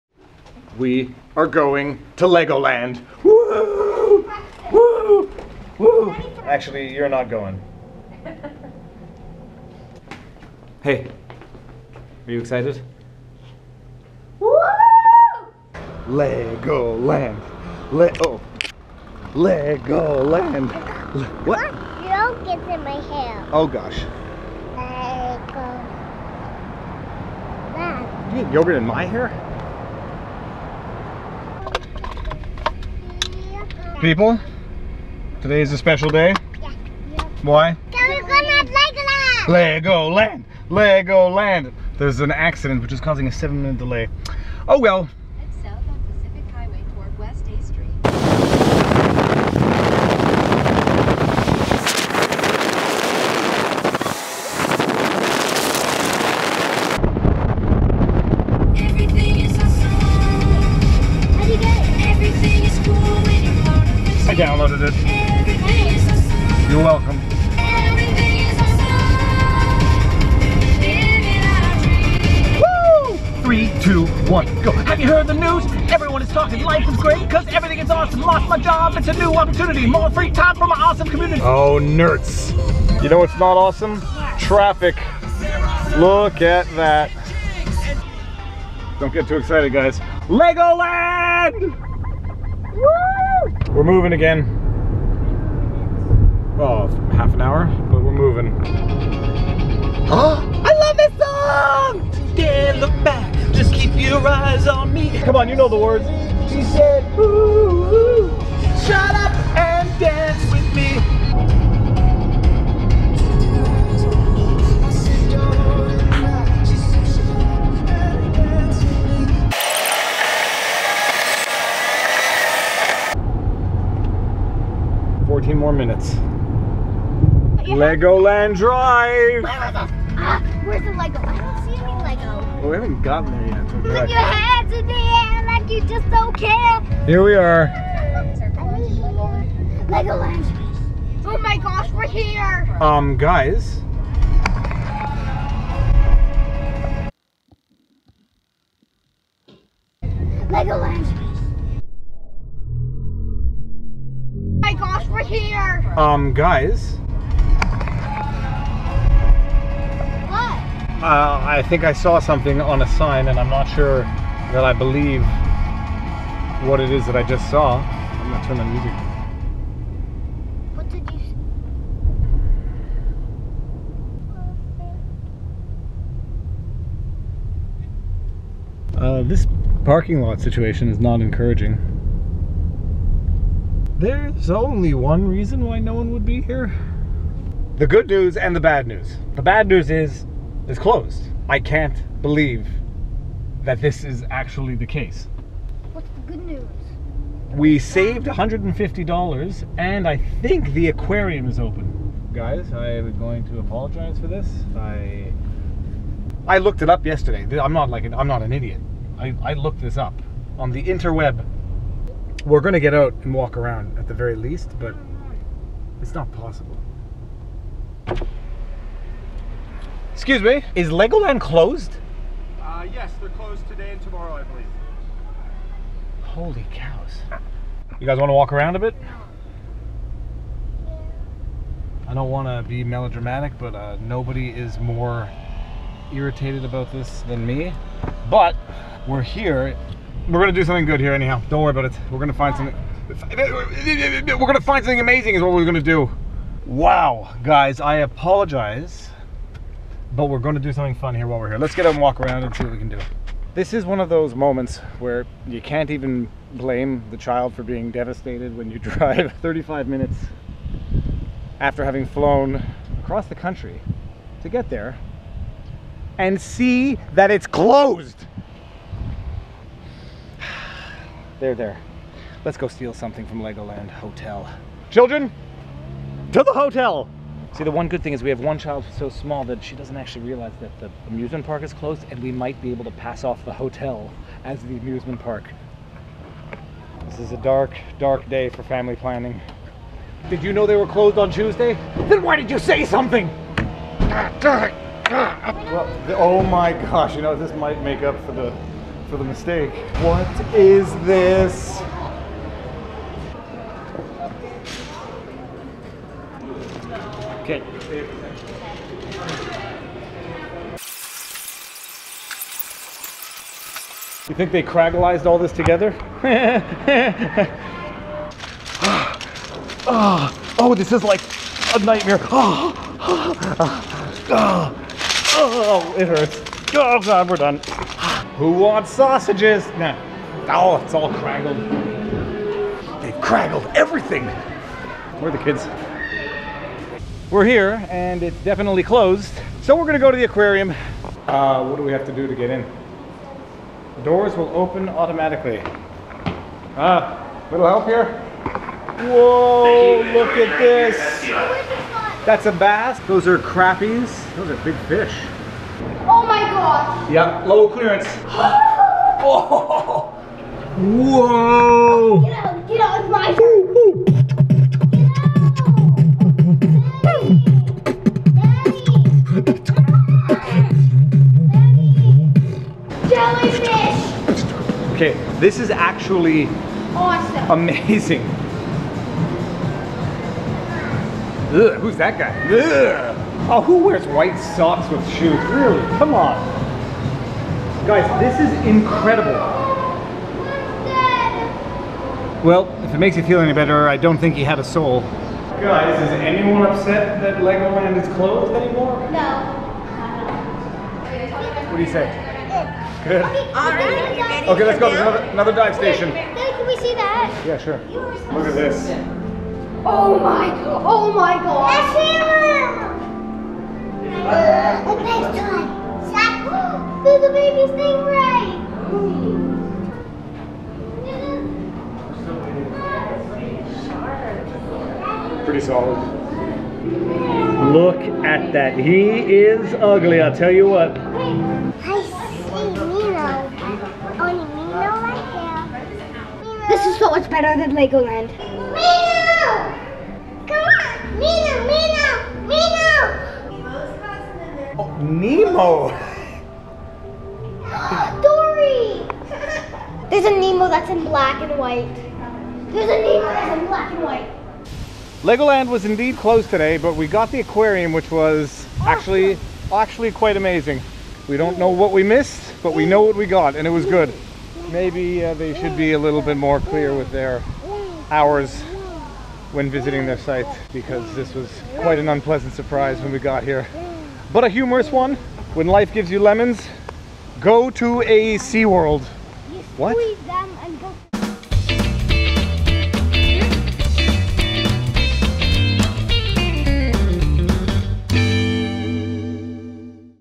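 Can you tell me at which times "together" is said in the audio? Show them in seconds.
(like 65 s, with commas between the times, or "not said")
315 s.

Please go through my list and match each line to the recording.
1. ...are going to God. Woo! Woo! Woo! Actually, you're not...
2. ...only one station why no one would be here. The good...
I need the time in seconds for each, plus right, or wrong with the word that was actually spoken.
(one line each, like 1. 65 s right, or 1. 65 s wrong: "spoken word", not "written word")
1. 1 s wrong: "Legoland", not "God"
2. 184 s wrong: "reason", not "station".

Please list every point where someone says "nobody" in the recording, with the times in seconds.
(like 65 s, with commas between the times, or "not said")
234 s.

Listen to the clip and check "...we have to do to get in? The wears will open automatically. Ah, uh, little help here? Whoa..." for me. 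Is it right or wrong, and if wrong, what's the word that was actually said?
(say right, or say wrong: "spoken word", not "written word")
wrong: "doors", not "wears".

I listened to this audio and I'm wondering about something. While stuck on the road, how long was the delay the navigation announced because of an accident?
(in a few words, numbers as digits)
7 minutes.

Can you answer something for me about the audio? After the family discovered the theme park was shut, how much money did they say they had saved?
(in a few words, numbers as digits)
$150.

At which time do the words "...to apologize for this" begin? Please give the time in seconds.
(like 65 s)
203 s.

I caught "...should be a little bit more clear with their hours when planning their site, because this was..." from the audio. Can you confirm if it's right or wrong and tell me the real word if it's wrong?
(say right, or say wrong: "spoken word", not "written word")
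wrong: "visiting", not "planning".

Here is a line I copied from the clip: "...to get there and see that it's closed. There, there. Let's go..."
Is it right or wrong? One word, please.
right.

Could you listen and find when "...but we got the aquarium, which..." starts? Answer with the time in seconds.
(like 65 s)
456 s.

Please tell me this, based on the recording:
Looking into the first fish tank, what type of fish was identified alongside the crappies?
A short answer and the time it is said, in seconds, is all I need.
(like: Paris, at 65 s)
bass, at 352 s.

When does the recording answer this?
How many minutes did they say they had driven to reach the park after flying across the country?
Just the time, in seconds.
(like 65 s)
259 s.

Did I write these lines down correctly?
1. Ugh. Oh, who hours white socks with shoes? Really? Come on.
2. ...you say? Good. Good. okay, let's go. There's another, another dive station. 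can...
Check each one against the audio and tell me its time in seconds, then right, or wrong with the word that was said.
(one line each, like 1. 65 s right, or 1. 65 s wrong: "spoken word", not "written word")
1. 382 s wrong: "wears", not "hours"
2. 401 s right.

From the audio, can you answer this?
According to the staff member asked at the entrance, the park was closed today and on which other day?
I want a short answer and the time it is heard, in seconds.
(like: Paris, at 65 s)
tomorrow, at 224 s.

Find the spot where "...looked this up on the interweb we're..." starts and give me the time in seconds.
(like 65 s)
209 s.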